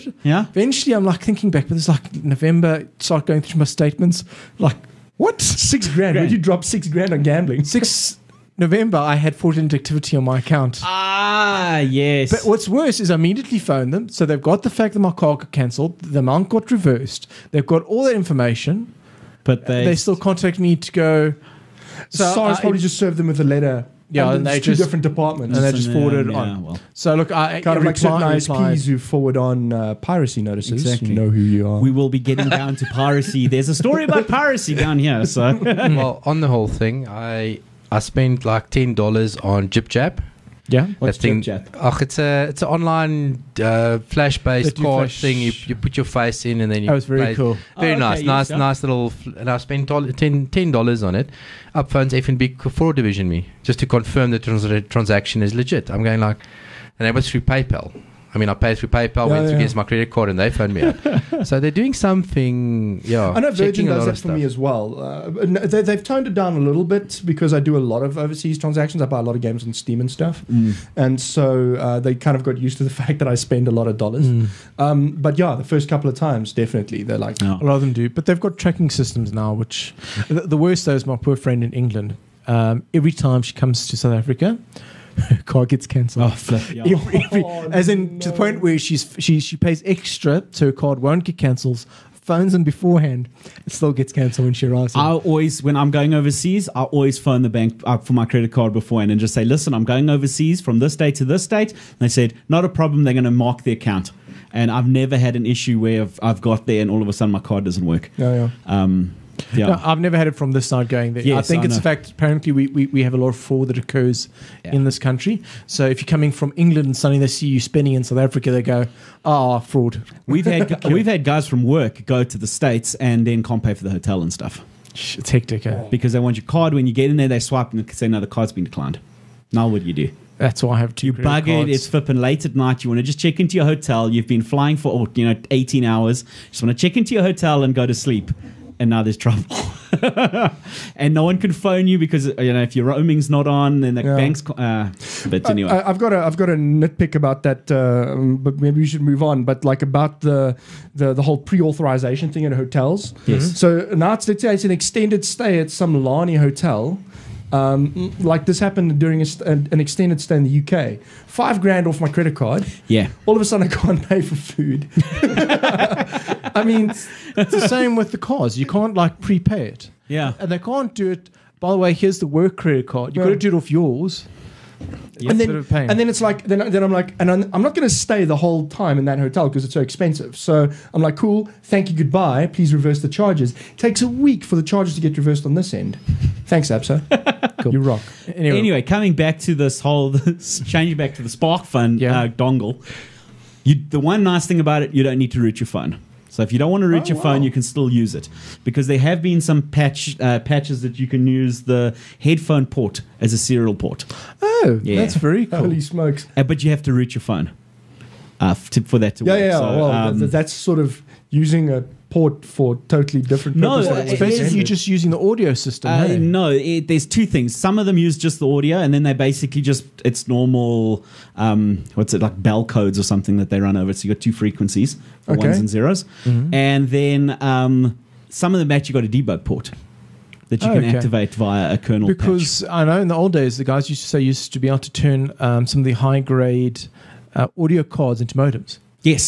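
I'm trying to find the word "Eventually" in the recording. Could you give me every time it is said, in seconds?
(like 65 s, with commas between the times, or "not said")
0 s.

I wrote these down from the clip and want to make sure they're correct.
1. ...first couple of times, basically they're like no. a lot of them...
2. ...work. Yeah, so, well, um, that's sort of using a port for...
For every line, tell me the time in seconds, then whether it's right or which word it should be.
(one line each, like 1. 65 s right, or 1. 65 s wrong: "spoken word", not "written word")
1. 75 s wrong: "definitely", not "basically"
2. 209 s right.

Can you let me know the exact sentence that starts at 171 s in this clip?
By the way, here's the work credit card.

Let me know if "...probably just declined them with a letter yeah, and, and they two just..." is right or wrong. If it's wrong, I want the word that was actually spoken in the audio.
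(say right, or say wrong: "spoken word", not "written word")
wrong: "served", not "declined".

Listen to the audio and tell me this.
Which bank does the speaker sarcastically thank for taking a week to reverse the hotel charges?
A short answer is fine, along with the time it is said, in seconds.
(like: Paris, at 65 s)
Absa, at 186 s.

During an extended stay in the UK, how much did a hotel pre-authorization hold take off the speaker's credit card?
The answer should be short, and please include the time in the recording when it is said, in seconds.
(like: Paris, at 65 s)
5 grand, at 161 s.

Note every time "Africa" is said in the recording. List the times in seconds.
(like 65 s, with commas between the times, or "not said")
84 s, 118 s.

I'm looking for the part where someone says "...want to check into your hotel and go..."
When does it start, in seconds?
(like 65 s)
136 s.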